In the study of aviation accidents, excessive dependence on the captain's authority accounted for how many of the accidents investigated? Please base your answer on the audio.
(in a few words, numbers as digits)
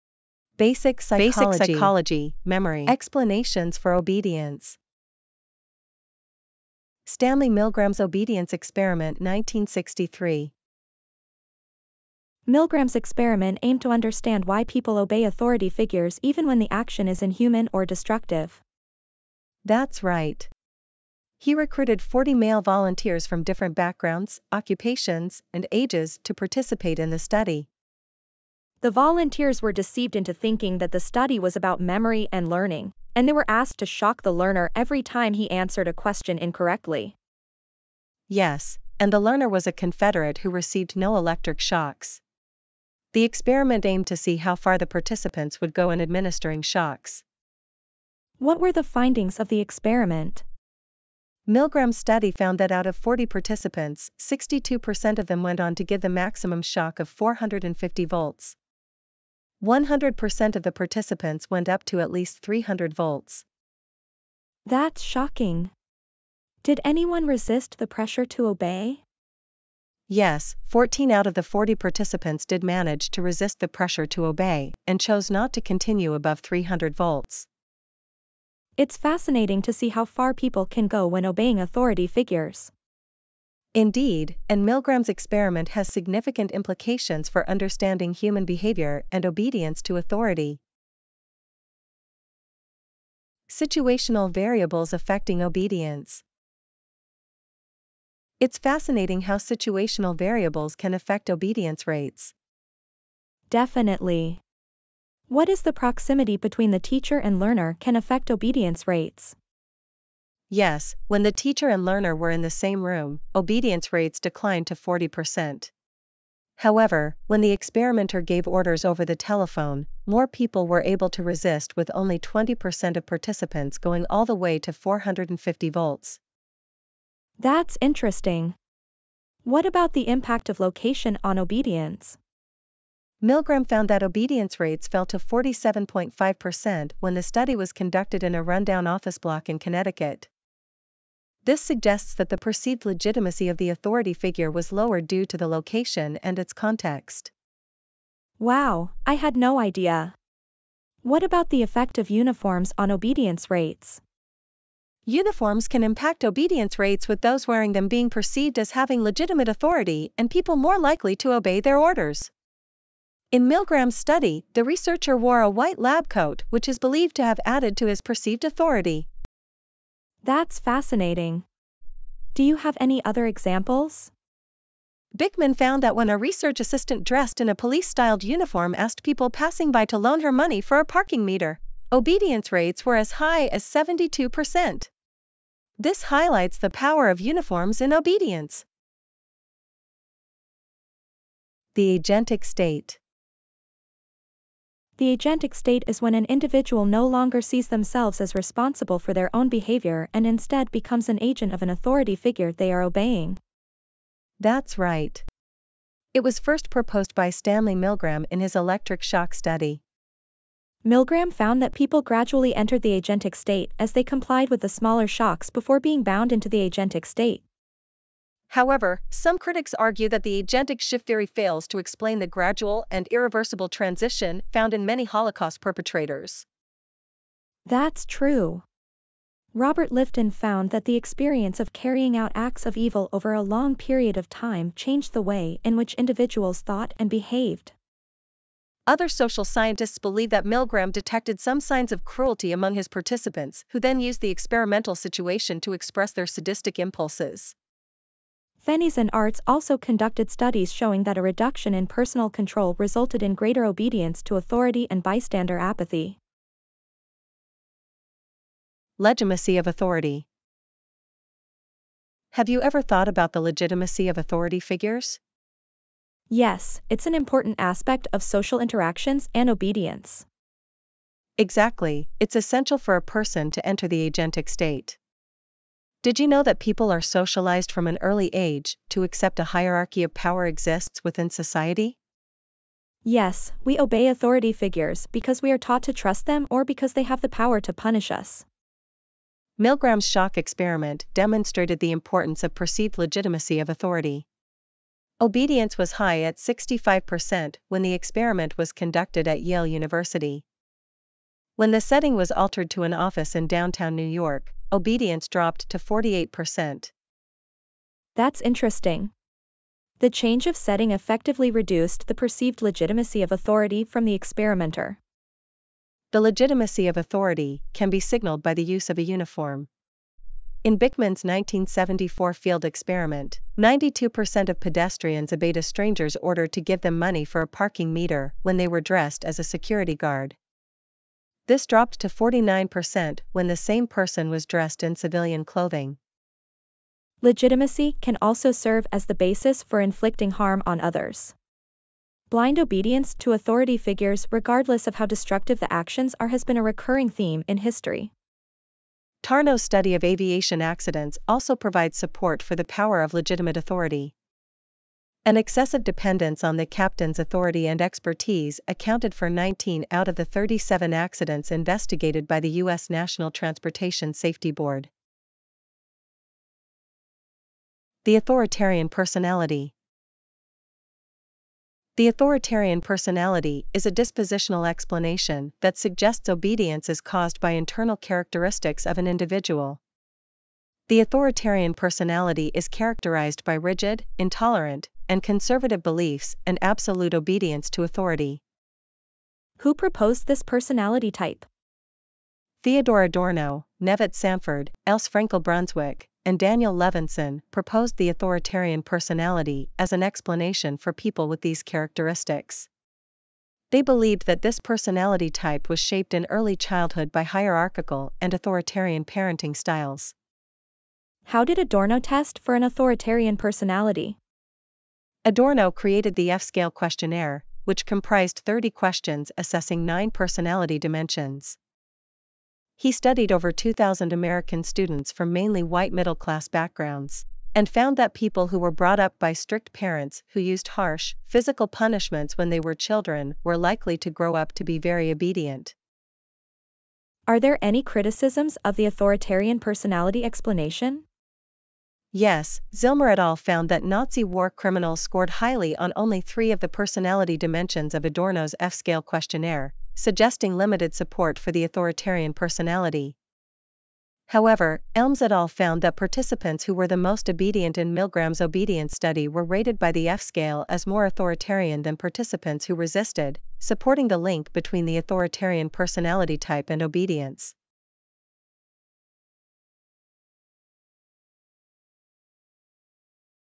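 19.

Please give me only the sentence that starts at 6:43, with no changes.
They believed that this personality type was shaped in early childhood by hierarchical and authoritarian parenting styles.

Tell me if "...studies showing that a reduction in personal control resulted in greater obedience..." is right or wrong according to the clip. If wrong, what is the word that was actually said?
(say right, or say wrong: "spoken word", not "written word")
right.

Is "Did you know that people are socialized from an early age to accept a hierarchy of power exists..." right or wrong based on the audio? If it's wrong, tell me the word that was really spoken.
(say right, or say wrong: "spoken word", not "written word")
right.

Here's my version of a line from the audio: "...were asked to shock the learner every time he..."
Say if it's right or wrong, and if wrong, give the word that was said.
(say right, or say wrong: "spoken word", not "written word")
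right.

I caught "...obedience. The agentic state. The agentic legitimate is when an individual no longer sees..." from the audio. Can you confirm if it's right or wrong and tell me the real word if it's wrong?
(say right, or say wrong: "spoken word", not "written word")
wrong: "state", not "legitimate".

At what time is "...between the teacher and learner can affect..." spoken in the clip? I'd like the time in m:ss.
1:46.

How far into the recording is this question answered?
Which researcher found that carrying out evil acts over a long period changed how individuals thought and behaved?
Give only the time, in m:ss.
3:49.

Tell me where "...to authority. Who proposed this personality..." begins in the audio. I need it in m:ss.
6:27.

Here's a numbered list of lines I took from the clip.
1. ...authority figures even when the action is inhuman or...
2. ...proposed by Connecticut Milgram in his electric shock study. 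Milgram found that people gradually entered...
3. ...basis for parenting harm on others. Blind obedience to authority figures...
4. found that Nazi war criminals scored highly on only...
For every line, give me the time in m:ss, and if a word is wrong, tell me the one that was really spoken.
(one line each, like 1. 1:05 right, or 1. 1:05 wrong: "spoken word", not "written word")
1. 0:15 right
2. 3:26 wrong: "Stanley", not "Connecticut"
3. 5:39 wrong: "inflicting", not "parenting"
4. 7:23 right.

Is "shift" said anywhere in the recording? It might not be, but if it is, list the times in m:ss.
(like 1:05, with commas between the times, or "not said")
3:40.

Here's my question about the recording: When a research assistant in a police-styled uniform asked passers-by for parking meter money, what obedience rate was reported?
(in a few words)
72%.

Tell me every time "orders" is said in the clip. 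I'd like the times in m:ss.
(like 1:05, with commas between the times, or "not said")
1:58, 2:41, 5:26.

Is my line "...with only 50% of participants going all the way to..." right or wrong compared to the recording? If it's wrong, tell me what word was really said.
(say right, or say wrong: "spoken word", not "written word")
wrong: "20", not "50".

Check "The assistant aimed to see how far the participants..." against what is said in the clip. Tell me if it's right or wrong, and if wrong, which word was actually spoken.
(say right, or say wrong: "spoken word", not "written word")
wrong: "experiment", not "assistant".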